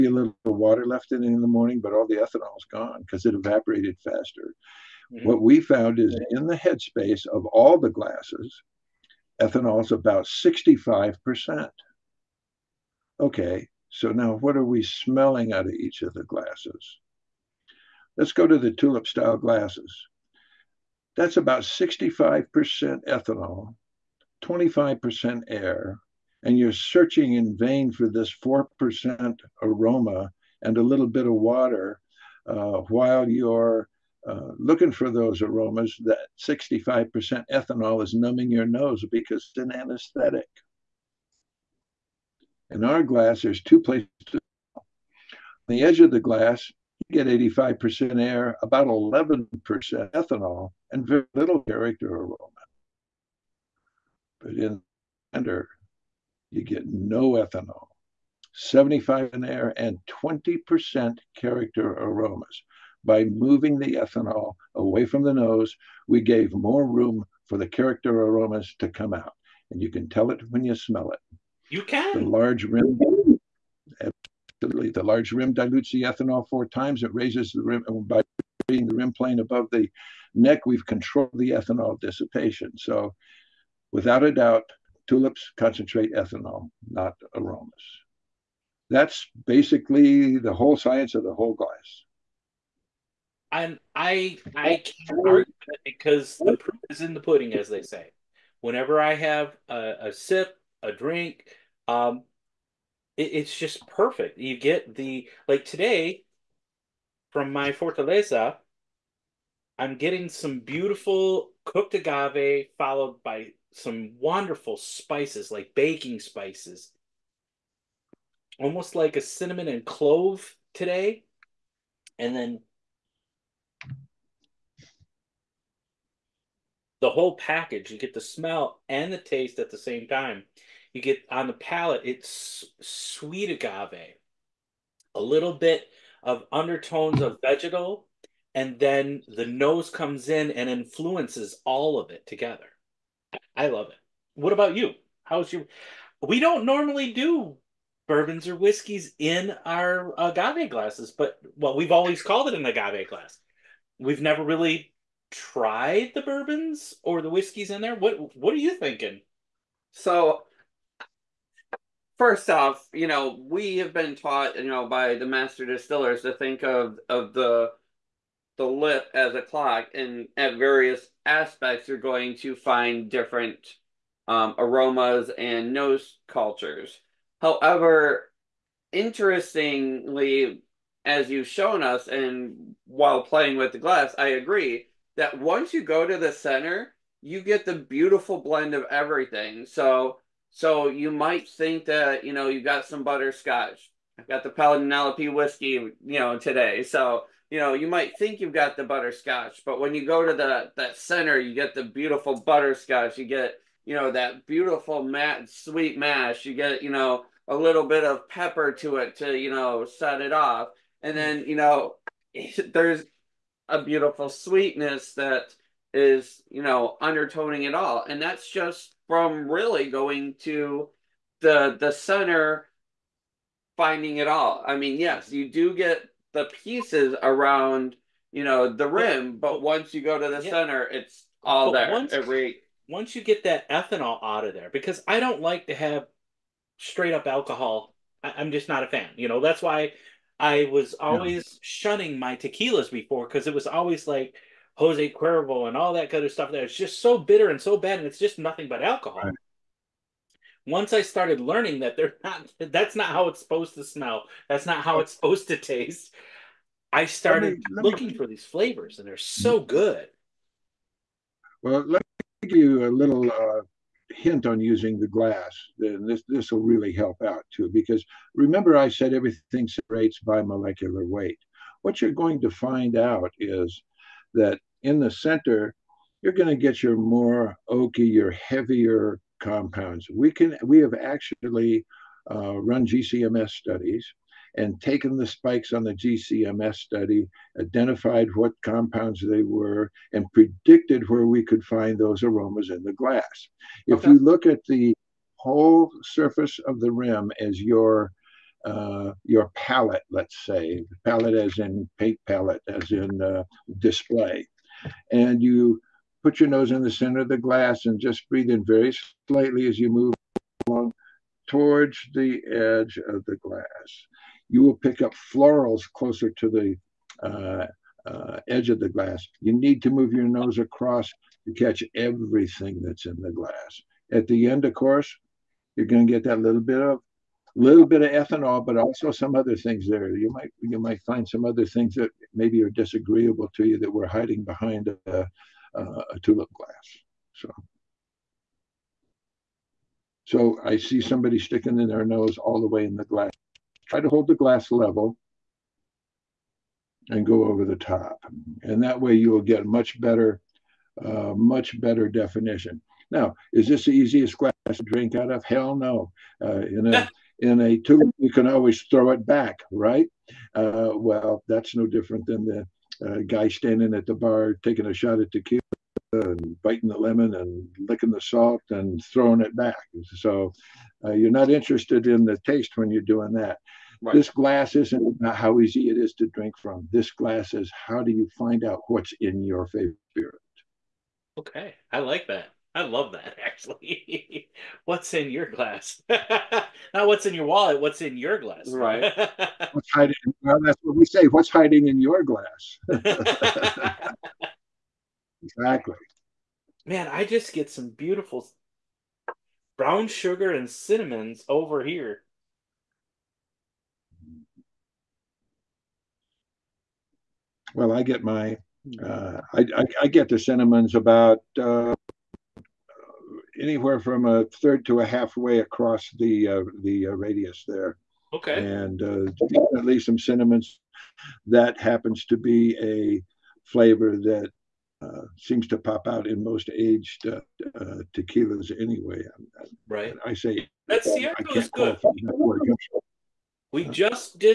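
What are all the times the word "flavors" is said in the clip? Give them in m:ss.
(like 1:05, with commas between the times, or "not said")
4:18, 7:03.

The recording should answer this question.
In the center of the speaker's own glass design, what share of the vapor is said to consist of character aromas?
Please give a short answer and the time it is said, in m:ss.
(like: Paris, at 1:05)
20%, at 1:00.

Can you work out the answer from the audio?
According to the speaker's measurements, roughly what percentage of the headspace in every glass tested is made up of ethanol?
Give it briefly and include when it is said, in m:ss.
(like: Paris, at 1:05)
65%, at 0:09.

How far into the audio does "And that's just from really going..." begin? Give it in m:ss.
3:38.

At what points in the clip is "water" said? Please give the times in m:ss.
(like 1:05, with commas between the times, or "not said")
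0:00, 0:31.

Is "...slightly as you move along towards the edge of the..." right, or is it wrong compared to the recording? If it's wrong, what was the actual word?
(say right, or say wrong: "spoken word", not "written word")
right.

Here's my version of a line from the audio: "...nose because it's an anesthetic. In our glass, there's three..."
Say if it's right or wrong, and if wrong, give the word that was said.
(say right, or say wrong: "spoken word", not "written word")
wrong: "two", not "three".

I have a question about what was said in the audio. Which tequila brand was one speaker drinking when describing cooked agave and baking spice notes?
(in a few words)
Fortaleza.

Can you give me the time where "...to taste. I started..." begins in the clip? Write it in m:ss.
4:15.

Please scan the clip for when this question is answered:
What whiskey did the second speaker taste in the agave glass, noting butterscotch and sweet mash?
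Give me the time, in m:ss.
3:14.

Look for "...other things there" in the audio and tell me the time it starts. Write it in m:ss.
5:29.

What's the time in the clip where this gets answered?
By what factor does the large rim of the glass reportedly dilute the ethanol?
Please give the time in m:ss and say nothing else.
1:16.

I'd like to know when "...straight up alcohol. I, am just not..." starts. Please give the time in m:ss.
3:56.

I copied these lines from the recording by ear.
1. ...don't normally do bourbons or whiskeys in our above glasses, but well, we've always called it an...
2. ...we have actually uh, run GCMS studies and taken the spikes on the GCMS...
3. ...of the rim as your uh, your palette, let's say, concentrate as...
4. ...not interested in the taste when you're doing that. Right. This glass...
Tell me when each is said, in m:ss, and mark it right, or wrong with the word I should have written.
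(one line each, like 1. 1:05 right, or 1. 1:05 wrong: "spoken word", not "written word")
1. 2:26 wrong: "agave", not "above"
2. 4:40 right
3. 4:56 wrong: "palette", not "concentrate"
4. 6:11 right.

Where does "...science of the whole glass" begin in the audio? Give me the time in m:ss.
1:30.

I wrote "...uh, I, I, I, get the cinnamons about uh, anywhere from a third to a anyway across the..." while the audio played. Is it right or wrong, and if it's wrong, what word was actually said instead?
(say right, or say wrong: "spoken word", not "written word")
wrong: "halfway", not "anyway".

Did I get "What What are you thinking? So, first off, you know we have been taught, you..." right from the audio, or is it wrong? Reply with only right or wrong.
right.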